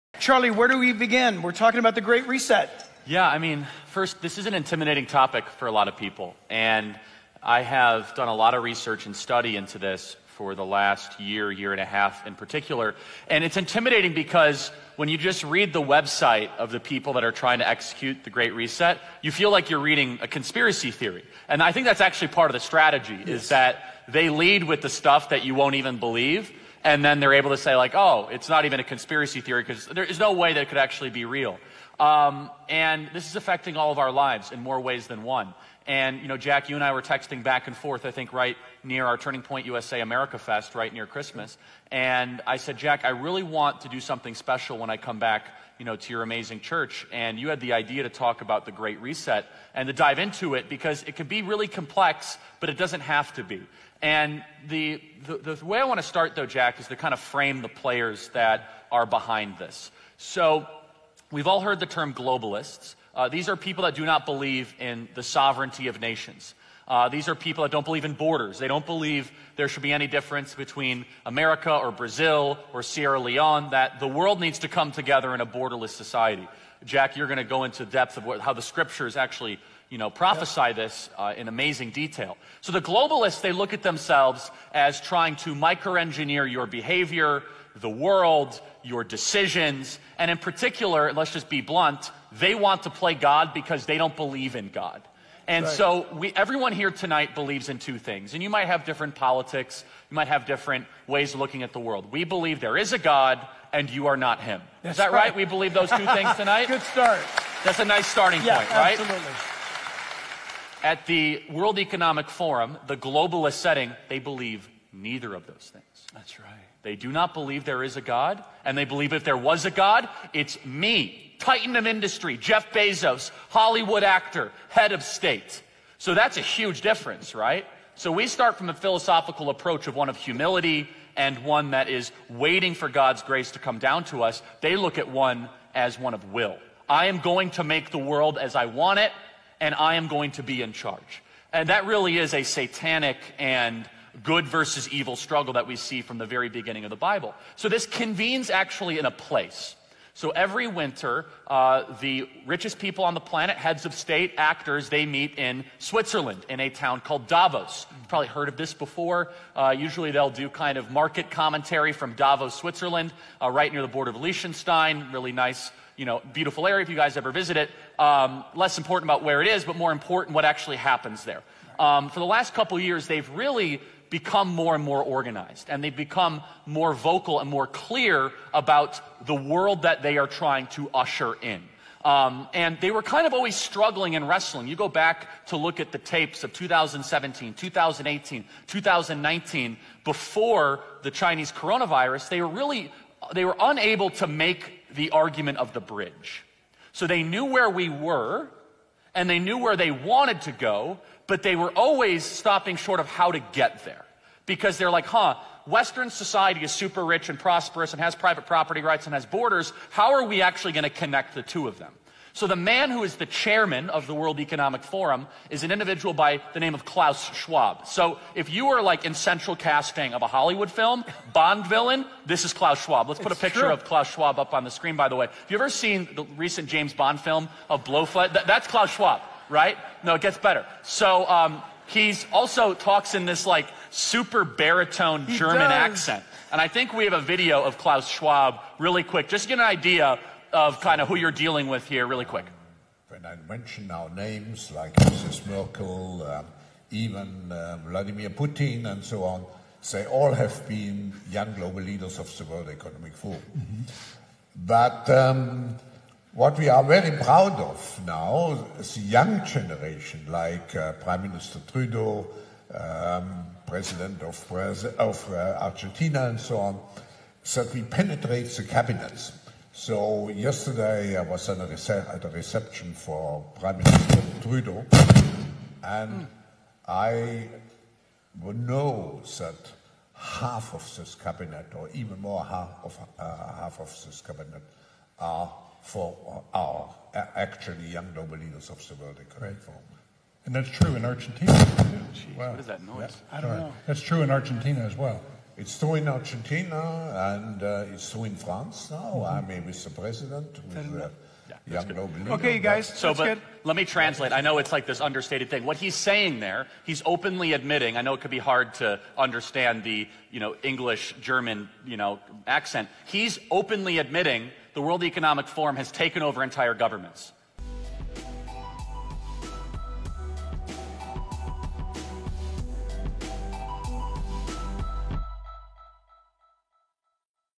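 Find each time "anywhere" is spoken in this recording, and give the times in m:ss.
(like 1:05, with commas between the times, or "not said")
not said.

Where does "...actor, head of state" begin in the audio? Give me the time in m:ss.
2:04.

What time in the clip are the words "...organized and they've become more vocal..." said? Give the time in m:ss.
2:55.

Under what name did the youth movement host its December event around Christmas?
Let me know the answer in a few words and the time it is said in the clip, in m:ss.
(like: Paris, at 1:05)
America Fest, at 0:40.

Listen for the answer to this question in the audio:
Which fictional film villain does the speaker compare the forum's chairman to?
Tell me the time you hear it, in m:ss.
3:47.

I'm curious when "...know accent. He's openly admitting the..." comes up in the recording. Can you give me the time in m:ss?
5:12.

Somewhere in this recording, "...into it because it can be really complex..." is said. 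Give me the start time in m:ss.
0:50.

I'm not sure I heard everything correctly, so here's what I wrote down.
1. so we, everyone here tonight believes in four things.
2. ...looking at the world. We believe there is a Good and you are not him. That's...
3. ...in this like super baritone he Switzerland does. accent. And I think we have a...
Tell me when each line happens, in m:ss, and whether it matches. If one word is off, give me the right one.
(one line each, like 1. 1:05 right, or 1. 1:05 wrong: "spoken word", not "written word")
1. 1:35 wrong: "two", not "four"
2. 1:41 wrong: "God", not "Good"
3. 3:53 wrong: "German", not "Switzerland".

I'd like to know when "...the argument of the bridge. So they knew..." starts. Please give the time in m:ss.
3:14.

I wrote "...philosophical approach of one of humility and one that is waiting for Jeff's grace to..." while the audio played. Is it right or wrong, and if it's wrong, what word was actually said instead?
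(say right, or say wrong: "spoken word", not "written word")
wrong: "God", not "Jeff".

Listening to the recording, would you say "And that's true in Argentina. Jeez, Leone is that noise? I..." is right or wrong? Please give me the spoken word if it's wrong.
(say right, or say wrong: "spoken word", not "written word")
wrong: "What", not "Leone".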